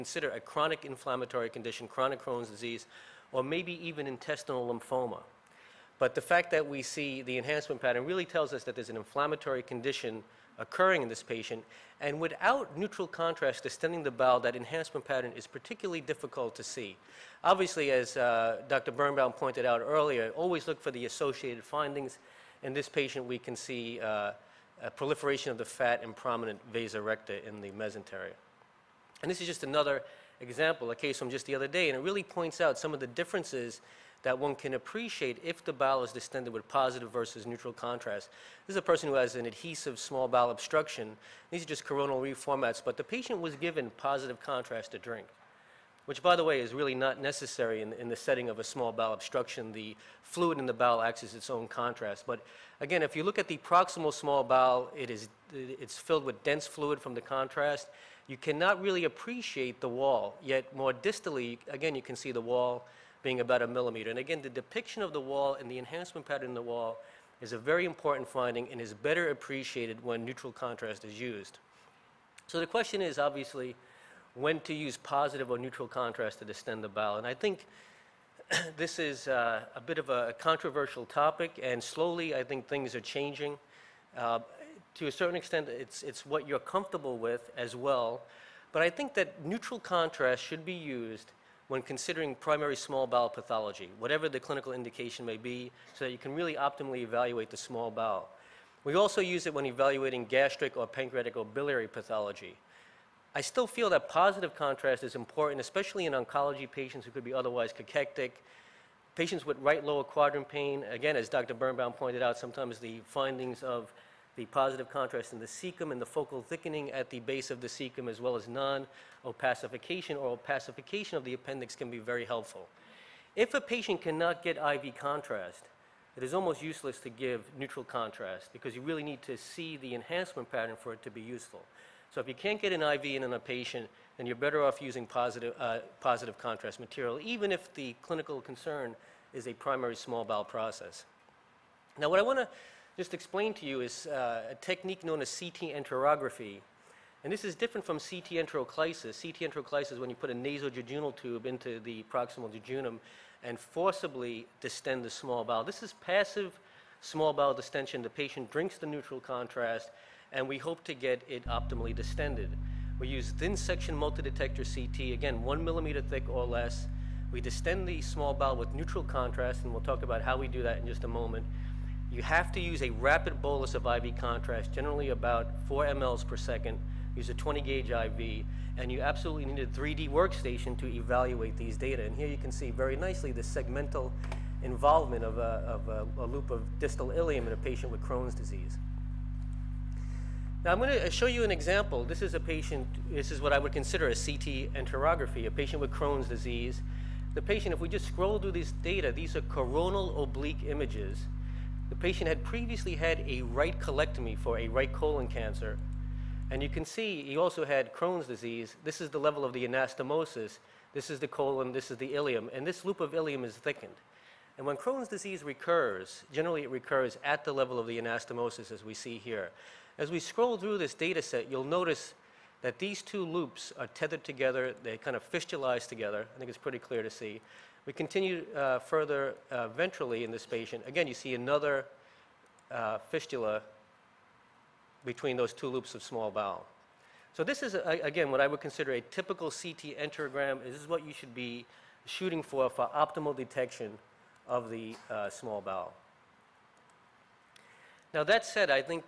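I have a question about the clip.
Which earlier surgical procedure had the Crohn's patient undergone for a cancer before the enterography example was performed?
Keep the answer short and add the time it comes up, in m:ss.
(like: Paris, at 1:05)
Right colectomy, at 3:23.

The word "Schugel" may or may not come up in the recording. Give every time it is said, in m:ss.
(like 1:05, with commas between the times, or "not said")
not said.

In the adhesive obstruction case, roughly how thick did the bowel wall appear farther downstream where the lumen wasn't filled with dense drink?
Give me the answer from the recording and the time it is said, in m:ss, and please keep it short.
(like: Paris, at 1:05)
1 millimeter, at 1:03.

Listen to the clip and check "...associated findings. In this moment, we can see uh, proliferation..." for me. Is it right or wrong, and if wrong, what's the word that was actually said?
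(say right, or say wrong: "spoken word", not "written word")
wrong: "patient", not "moment".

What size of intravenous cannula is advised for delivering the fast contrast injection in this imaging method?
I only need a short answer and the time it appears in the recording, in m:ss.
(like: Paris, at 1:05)
20 gauge, at 2:57.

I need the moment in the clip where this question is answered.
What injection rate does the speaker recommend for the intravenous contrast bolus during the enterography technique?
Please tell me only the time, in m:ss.
2:55.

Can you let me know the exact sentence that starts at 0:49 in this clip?
The fluid in the bowel acts as its own contrast.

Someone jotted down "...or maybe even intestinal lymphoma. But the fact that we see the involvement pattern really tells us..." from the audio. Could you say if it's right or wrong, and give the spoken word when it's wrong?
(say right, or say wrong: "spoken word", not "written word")
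wrong: "enhancement", not "involvement".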